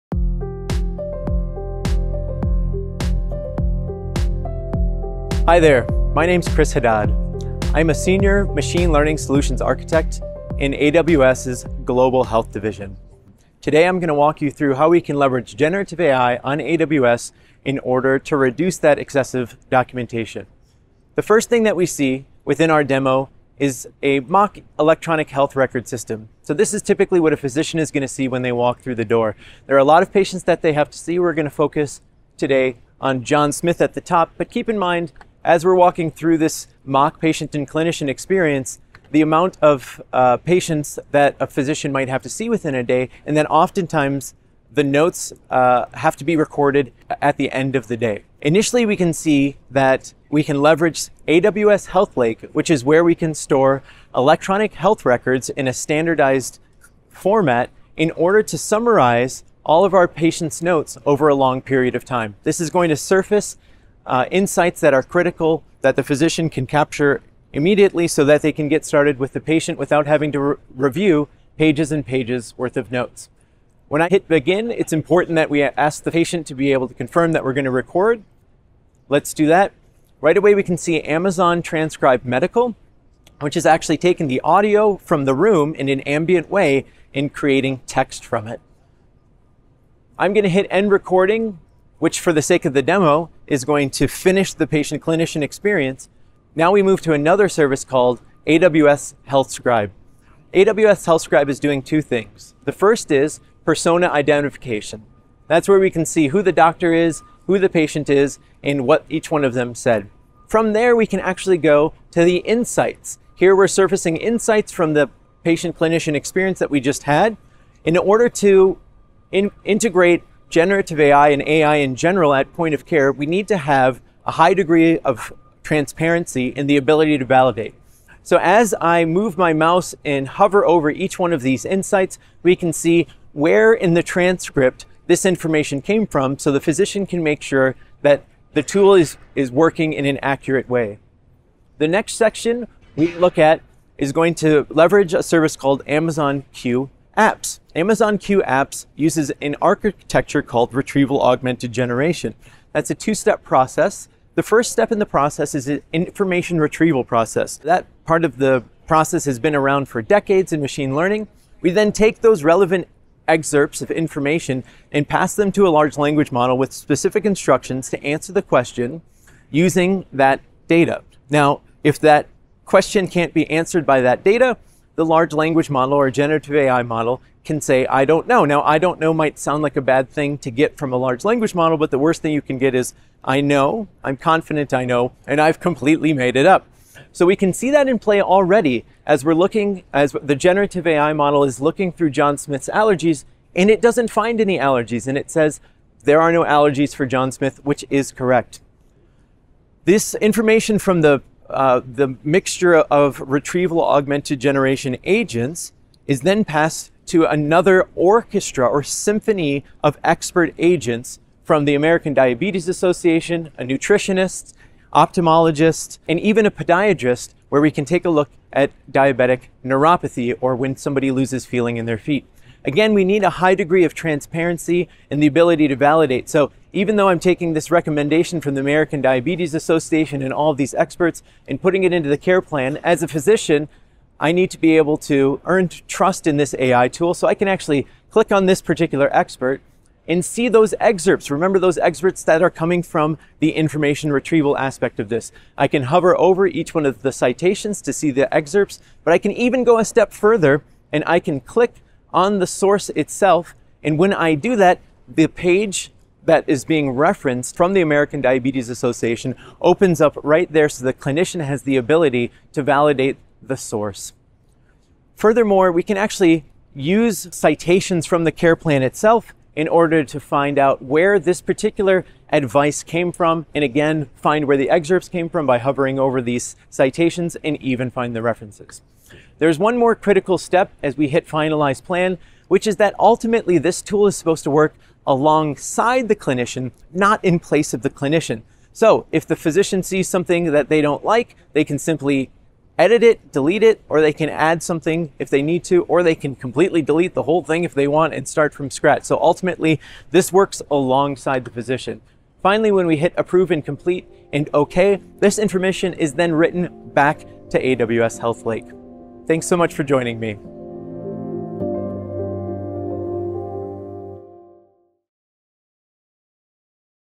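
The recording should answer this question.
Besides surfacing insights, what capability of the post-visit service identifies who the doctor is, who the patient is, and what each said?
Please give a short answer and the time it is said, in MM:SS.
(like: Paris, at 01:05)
Persona identification, at 01:43.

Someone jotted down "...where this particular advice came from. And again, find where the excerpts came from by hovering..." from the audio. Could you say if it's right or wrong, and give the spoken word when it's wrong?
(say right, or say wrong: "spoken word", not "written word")
right.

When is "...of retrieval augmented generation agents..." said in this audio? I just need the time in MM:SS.
03:22.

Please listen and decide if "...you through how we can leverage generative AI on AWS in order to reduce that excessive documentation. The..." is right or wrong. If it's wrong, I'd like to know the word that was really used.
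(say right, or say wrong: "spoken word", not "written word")
right.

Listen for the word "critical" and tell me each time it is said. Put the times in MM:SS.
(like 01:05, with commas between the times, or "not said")
01:05, 04:39.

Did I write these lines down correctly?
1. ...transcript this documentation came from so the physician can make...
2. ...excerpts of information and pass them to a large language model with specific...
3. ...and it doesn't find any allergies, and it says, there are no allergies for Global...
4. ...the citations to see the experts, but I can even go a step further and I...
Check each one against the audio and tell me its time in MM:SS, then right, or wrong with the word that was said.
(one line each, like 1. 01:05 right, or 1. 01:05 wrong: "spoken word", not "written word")
1. 02:14 wrong: "information", not "documentation"
2. 02:43 right
3. 03:13 wrong: "John", not "Global"
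4. 04:07 wrong: "excerpts", not "experts".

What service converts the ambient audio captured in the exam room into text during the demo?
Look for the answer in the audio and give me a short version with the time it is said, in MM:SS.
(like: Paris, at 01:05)
Amazon Transcribe Medical, at 01:21.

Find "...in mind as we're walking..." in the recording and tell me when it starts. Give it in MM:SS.
00:34.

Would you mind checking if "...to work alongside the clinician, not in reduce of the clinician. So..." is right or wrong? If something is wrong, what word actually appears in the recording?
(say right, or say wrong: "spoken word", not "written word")
wrong: "place", not "reduce".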